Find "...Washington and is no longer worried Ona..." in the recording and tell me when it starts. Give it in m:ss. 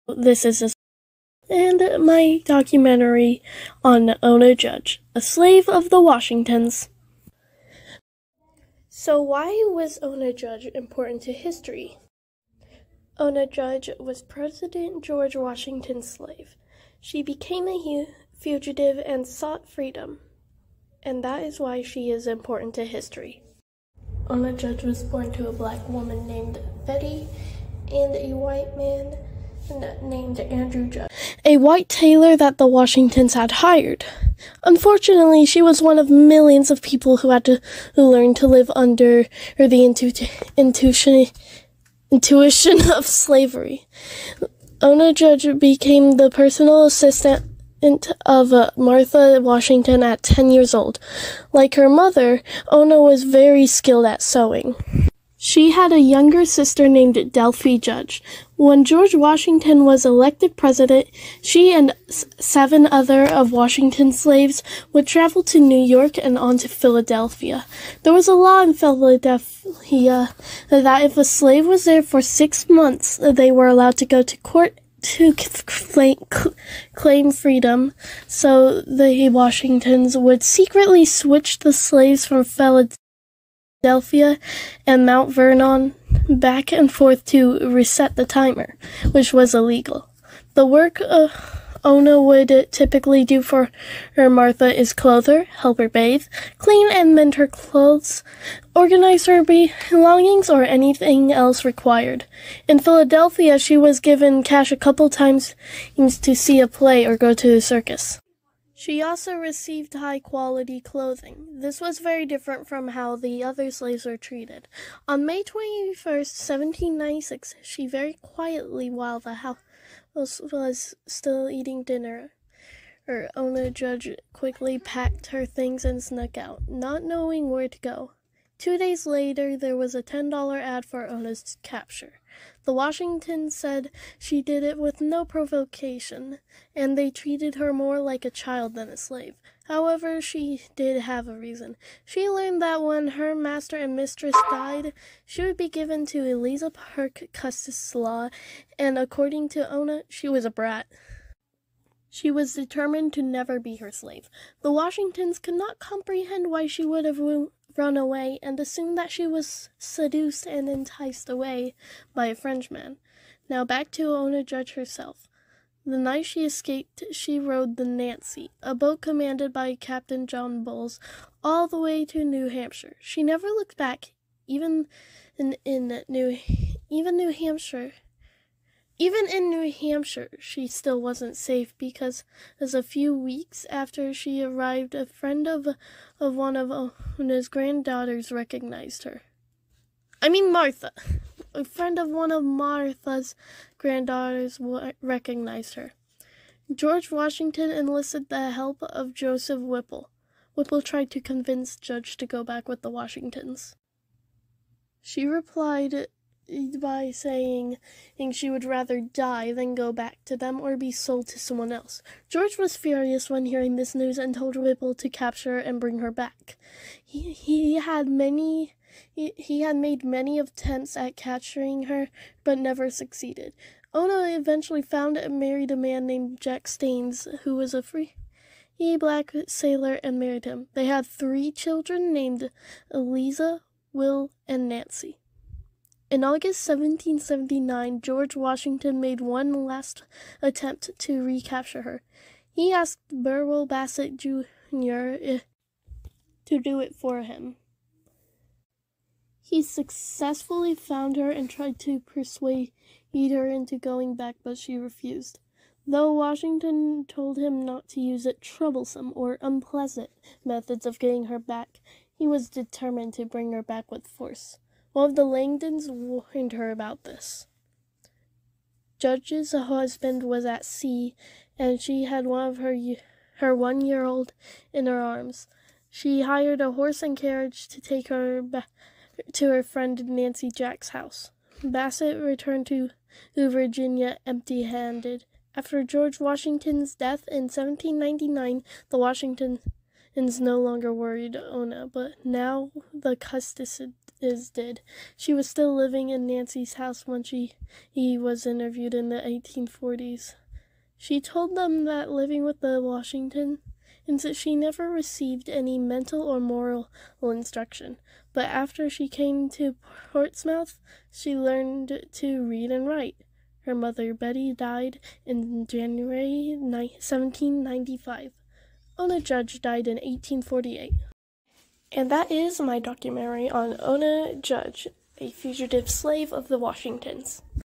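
4:48.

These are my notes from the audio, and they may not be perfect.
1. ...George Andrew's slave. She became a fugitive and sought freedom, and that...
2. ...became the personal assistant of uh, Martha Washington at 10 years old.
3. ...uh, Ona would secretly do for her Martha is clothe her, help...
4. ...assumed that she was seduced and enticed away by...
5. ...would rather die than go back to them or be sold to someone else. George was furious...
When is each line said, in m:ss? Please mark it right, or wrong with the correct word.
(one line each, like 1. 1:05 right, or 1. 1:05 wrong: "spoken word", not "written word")
1. 0:15 wrong: "Washington", not "Andrew"
2. 0:45 right
3. 1:31 wrong: "typically", not "secretly"
4. 2:38 right
5. 3:28 right.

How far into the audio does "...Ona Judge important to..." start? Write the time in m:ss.
0:10.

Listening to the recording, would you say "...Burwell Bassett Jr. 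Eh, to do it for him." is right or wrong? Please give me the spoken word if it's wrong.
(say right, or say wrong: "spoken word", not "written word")
right.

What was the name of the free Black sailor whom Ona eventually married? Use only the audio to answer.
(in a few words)
Jack Staines.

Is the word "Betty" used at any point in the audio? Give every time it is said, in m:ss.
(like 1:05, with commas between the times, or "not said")
0:26, 5:14.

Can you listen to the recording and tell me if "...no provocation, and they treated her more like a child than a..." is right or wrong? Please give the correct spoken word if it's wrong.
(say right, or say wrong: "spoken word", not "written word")
right.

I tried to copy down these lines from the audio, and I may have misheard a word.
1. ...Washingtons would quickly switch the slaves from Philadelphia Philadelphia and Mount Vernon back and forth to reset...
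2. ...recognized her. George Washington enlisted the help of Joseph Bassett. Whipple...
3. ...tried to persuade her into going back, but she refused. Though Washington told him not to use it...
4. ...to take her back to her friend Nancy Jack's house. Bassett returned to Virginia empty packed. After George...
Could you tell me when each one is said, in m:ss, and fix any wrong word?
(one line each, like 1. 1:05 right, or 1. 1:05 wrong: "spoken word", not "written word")
1. 1:19 wrong: "secretly", not "quickly"
2. 3:15 wrong: "Whipple", not "Bassett"
3. 4:11 right
4. 4:37 wrong: "handed", not "packed".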